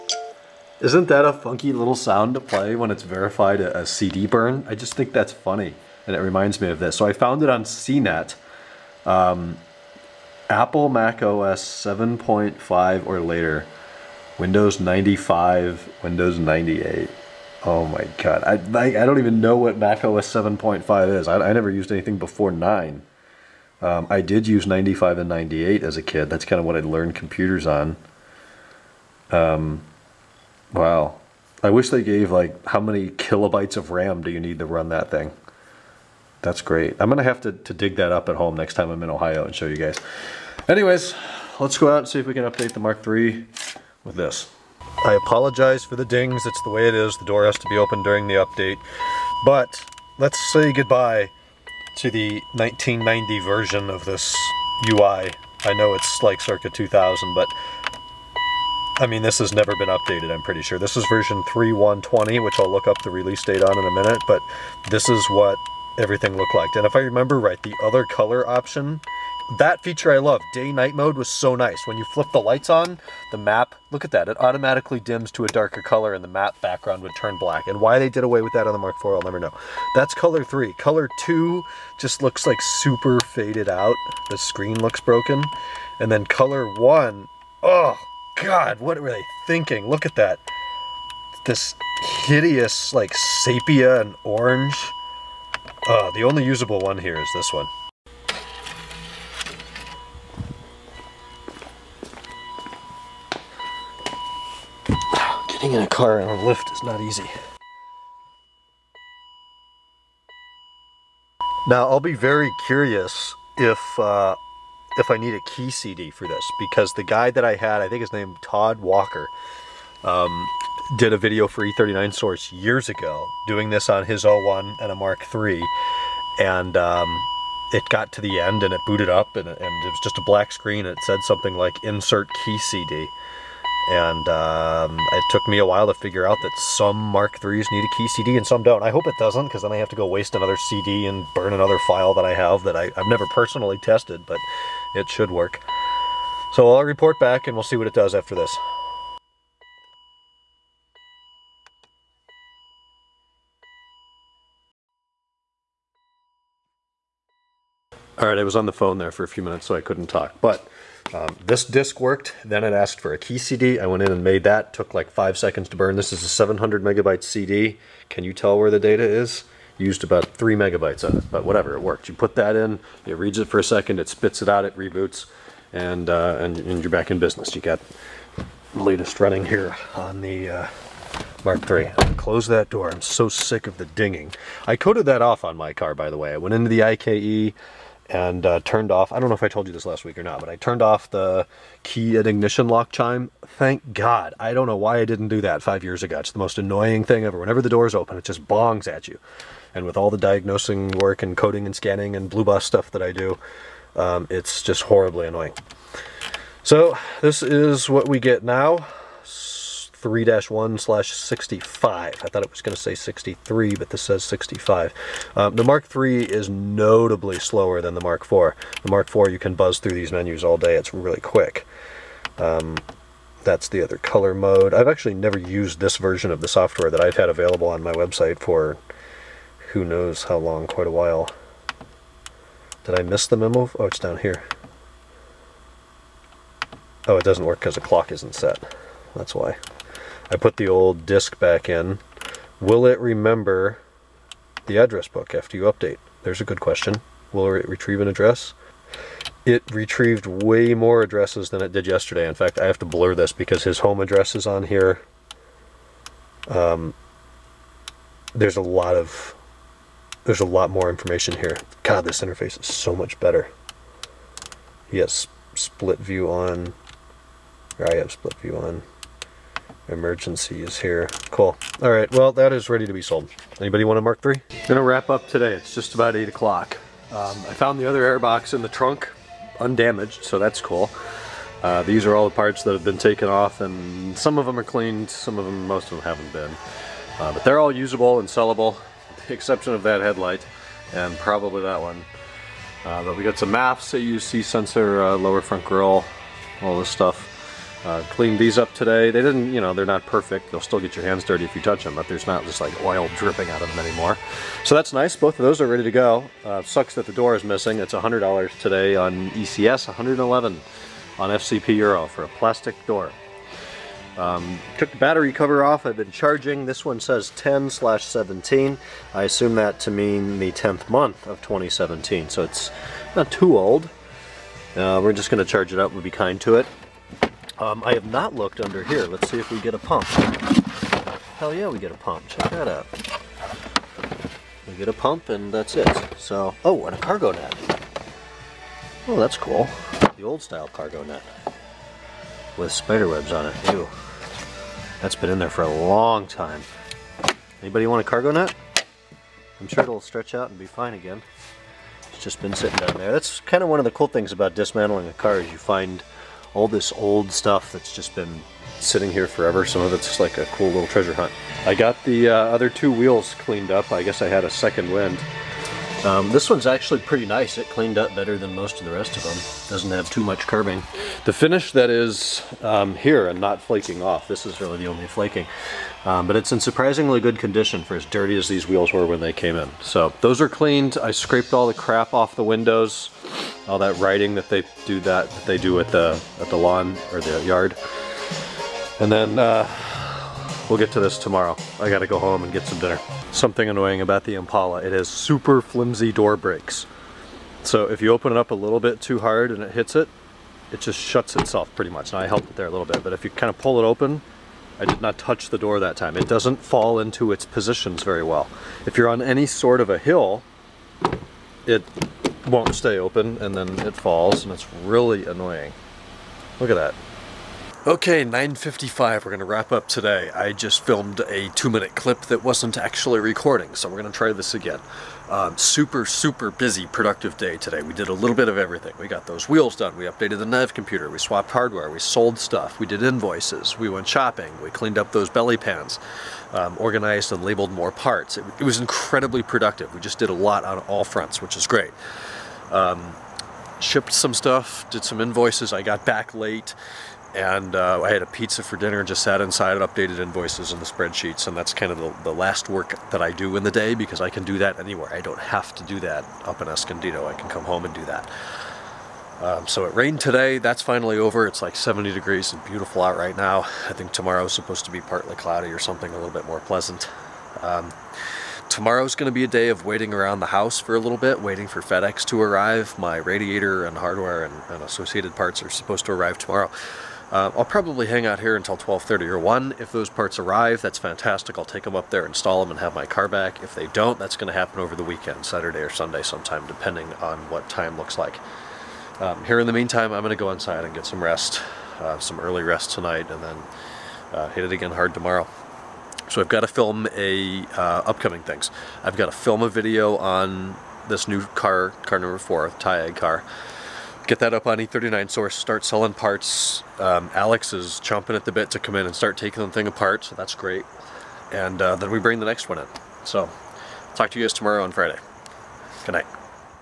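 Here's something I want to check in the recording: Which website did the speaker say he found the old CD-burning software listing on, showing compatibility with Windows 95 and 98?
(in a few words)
CNET.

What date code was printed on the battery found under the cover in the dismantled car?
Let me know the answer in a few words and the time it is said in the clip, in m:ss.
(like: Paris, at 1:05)
10/17, at 5:17.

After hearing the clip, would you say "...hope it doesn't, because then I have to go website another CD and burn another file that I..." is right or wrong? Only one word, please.
wrong.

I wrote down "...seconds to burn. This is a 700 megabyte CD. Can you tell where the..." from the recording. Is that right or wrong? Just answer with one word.
right.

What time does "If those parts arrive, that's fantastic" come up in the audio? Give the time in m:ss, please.
7:59.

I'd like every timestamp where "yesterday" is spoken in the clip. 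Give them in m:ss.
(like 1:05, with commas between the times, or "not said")
4:11.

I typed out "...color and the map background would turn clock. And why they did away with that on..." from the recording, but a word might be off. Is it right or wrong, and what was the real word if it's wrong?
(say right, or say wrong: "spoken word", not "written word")
wrong: "black", not "clock".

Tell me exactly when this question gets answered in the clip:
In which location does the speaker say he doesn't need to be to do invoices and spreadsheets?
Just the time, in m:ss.
7:36.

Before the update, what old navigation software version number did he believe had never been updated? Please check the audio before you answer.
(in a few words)
3120.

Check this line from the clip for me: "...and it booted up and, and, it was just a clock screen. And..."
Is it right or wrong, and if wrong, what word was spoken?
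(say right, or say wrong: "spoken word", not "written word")
wrong: "black", not "clock".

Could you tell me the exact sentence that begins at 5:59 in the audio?
Some of it's just like a cool little treasure hunt.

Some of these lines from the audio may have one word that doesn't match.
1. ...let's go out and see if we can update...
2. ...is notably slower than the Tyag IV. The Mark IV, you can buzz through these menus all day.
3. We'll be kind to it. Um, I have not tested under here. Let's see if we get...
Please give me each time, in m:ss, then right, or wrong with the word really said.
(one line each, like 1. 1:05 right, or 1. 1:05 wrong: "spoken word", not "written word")
1. 0:41 right
2. 3:36 wrong: "Mark", not "Tyag"
3. 5:25 wrong: "looked", not "tested".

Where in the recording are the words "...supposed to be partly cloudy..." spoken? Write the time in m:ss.
7:44.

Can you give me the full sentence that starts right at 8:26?
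Um, Alex is chomping at the bit to come in and start taking the thing apart, so that's great.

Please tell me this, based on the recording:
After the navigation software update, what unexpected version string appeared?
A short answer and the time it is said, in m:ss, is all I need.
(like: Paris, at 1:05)
3-1/65, at 3:30.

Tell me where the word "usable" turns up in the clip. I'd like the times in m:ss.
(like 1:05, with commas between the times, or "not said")
1:36, 4:47.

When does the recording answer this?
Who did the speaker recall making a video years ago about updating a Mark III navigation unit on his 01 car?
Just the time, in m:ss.
1:58.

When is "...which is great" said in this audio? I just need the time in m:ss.
7:21.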